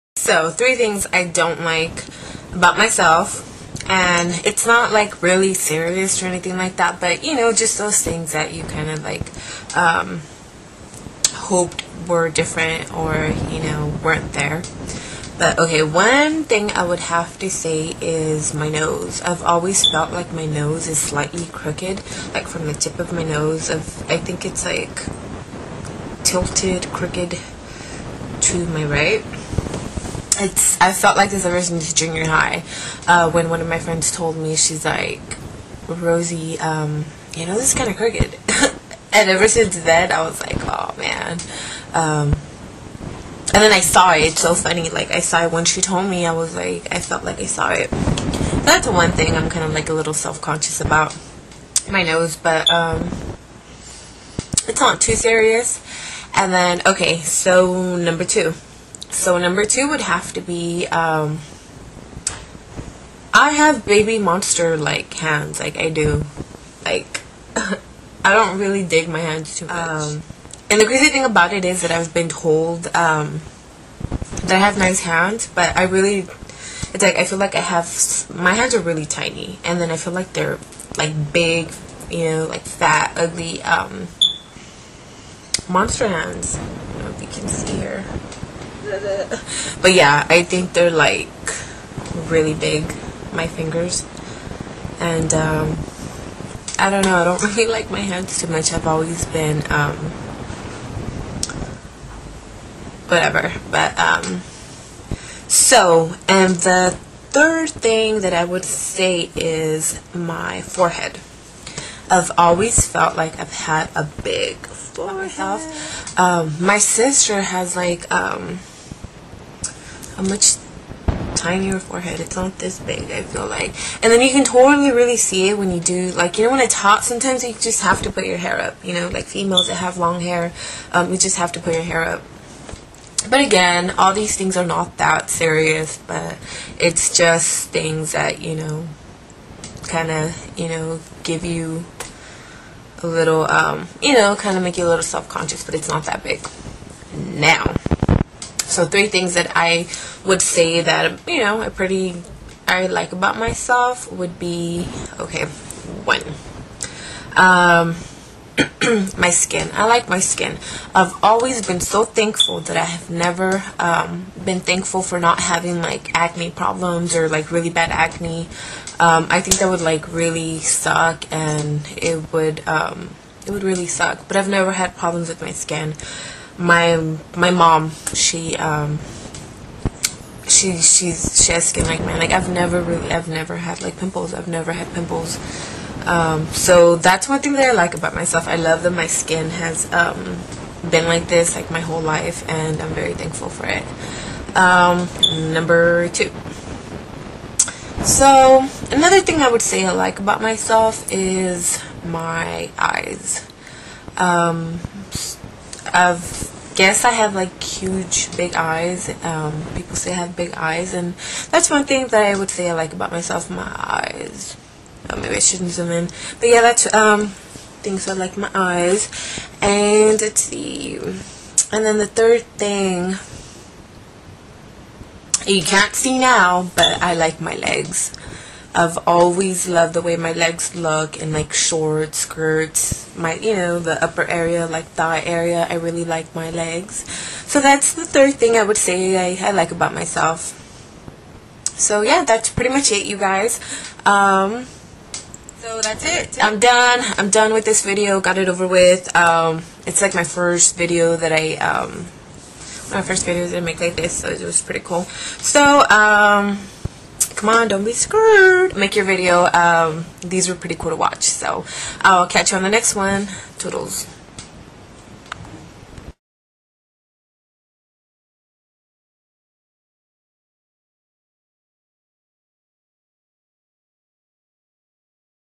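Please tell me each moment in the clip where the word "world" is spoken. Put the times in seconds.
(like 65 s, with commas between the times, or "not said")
not said.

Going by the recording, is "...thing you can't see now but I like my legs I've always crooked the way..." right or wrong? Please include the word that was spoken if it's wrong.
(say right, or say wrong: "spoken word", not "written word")
wrong: "loved", not "crooked".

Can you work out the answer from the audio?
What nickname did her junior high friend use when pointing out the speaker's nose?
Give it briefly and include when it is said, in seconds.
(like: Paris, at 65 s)
Rosy, at 35 s.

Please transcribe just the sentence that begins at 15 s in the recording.
But okay, one thing I would have to say is my nose.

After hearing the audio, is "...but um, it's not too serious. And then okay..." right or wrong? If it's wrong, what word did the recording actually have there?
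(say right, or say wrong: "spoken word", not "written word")
right.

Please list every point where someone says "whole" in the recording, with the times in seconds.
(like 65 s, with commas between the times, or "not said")
191 s.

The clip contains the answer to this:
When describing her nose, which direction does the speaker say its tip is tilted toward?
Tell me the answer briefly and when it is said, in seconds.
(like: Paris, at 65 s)
Right, at 28 s.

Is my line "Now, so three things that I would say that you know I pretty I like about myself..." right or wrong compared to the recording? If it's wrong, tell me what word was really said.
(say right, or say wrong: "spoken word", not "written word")
right.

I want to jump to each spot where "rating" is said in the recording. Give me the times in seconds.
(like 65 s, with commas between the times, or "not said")
not said.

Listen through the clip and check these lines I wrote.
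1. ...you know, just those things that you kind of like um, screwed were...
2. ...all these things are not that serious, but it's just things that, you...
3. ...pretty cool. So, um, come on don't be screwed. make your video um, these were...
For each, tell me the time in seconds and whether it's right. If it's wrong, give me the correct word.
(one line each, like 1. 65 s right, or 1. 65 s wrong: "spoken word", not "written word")
1. 7 s wrong: "hoped", not "screwed"
2. 133 s right
3. 254 s right.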